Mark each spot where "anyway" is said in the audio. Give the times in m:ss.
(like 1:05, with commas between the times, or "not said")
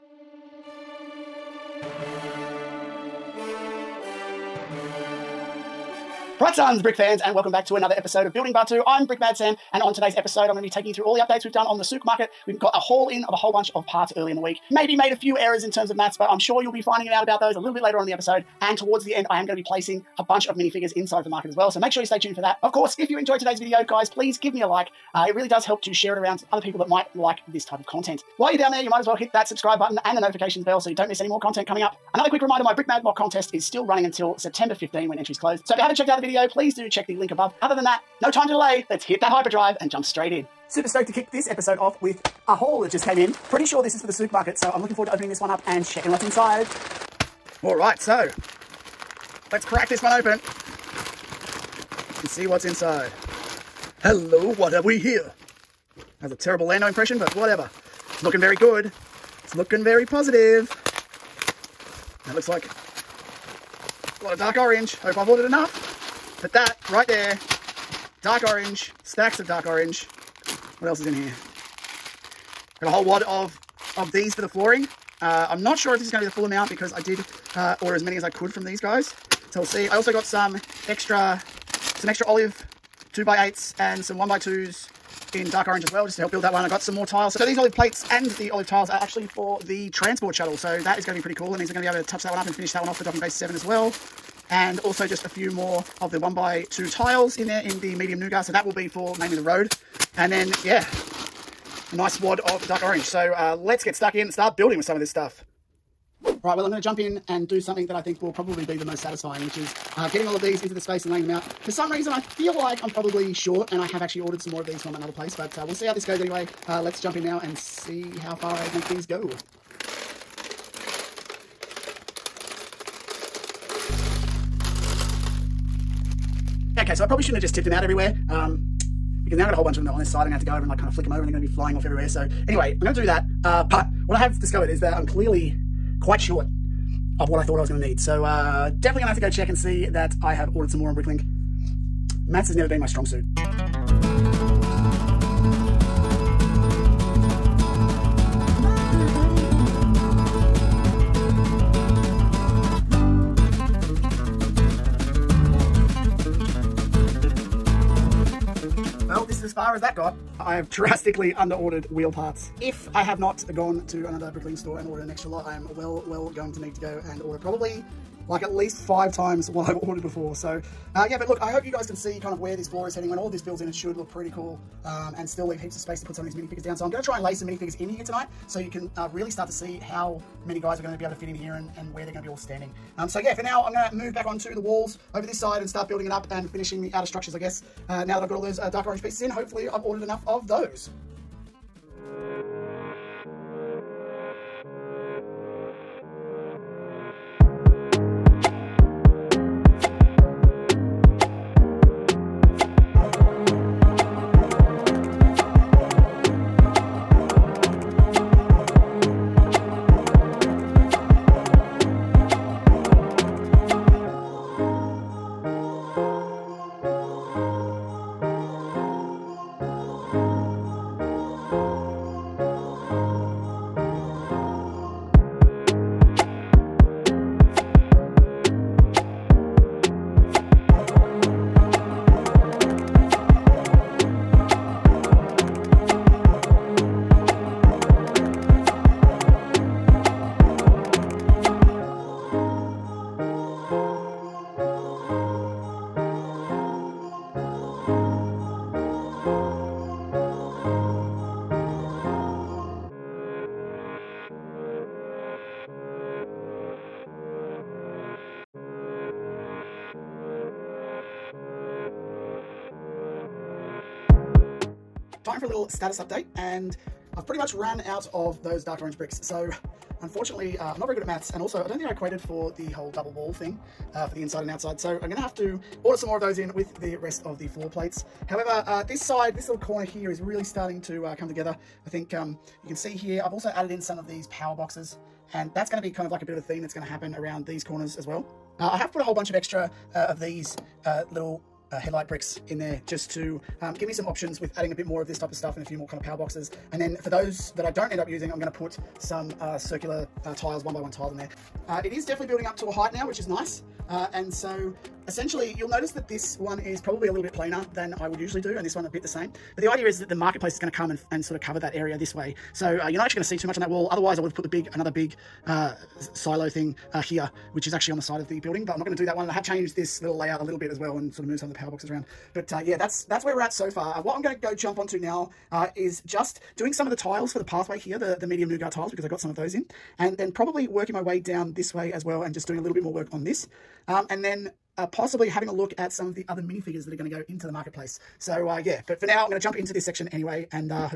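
1:56, 2:12, 5:40.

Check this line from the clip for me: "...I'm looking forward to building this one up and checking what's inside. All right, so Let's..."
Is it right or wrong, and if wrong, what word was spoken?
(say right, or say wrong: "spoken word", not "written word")
wrong: "opening", not "building".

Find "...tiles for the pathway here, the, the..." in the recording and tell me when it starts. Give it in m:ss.
5:26.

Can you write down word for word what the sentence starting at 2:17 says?
So uh, definitely going to have to go check and see that I have ordered some more on Bricklink.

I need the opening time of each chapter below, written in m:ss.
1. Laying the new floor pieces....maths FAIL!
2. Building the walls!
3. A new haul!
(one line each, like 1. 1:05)
1. 1:46
2. 3:10
3. 0:40.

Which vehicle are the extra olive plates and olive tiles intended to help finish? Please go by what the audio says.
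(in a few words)
the transport shuttle.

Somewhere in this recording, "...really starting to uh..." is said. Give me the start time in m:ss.
4:40.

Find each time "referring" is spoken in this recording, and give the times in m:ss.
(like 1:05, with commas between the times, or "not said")
not said.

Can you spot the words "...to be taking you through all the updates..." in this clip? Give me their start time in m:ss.
0:10.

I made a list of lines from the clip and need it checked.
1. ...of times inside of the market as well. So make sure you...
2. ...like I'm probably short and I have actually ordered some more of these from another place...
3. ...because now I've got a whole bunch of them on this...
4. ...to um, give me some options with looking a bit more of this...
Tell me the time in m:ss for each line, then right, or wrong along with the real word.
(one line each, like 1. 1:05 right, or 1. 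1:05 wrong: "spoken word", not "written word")
1. 0:20 wrong: "minifigures", not "times"
2. 1:52 right
3. 2:09 right
4. 4:53 wrong: "adding", not "looking".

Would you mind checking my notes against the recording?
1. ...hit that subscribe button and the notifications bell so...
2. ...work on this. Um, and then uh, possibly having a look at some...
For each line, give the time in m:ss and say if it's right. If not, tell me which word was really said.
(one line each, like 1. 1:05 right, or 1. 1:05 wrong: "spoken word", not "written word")
1. 0:29 right
2. 5:32 right.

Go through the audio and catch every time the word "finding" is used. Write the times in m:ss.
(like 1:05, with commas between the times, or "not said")
0:16.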